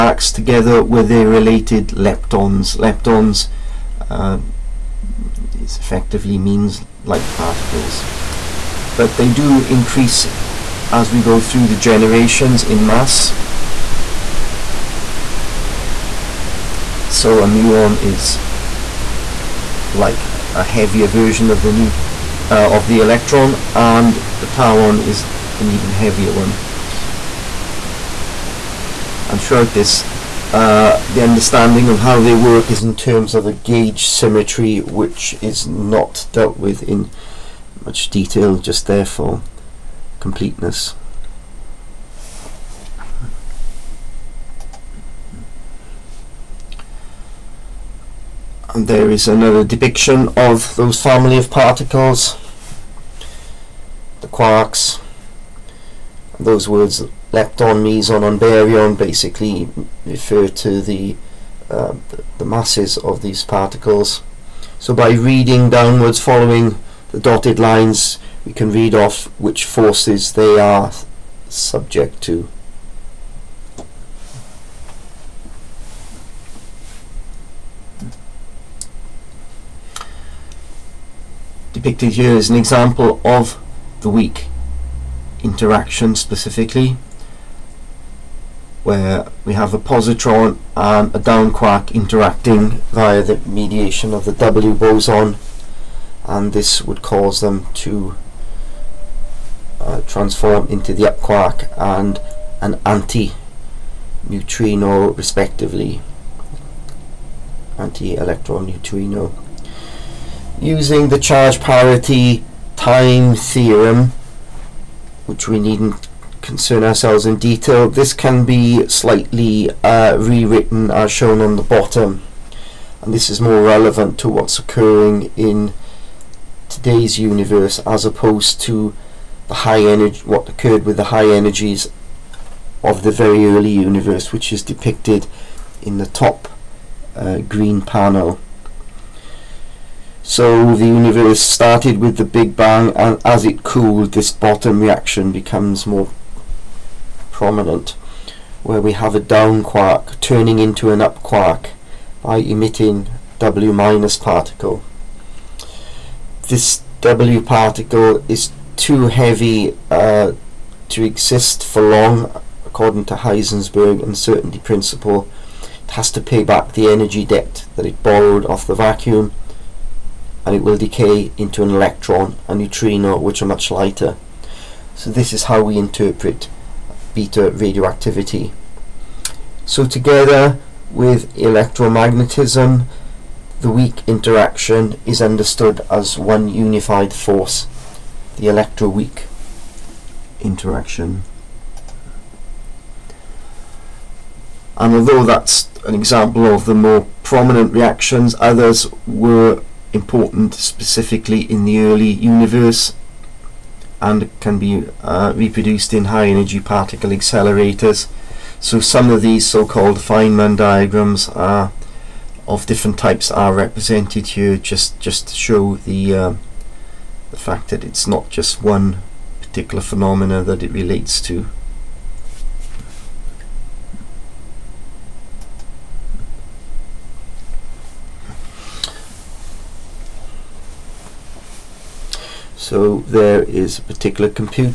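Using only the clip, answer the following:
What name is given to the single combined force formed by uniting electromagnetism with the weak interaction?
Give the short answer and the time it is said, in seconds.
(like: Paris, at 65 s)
electroweak interaction, at 188 s.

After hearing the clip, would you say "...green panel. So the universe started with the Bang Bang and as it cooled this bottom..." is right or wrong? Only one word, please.
wrong.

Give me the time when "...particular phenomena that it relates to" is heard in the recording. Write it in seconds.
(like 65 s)
219 s.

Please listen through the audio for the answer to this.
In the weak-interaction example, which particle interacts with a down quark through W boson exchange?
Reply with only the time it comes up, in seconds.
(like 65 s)
89 s.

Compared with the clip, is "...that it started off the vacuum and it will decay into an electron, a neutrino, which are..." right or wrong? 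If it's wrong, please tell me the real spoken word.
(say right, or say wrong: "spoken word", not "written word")
wrong: "borrowed", not "started".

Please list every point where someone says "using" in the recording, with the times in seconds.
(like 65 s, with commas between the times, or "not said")
110 s.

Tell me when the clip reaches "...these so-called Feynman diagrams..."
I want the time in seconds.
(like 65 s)
209 s.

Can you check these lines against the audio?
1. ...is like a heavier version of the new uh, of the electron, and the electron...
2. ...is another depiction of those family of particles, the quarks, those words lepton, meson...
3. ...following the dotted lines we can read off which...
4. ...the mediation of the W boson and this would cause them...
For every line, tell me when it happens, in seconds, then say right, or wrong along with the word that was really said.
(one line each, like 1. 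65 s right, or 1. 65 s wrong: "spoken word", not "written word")
1. 18 s wrong: "tauon", not "electron"
2. 49 s right
3. 66 s right
4. 93 s right.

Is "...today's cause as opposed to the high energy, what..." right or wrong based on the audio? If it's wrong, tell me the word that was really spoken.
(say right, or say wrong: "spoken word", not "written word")
wrong: "universe", not "cause".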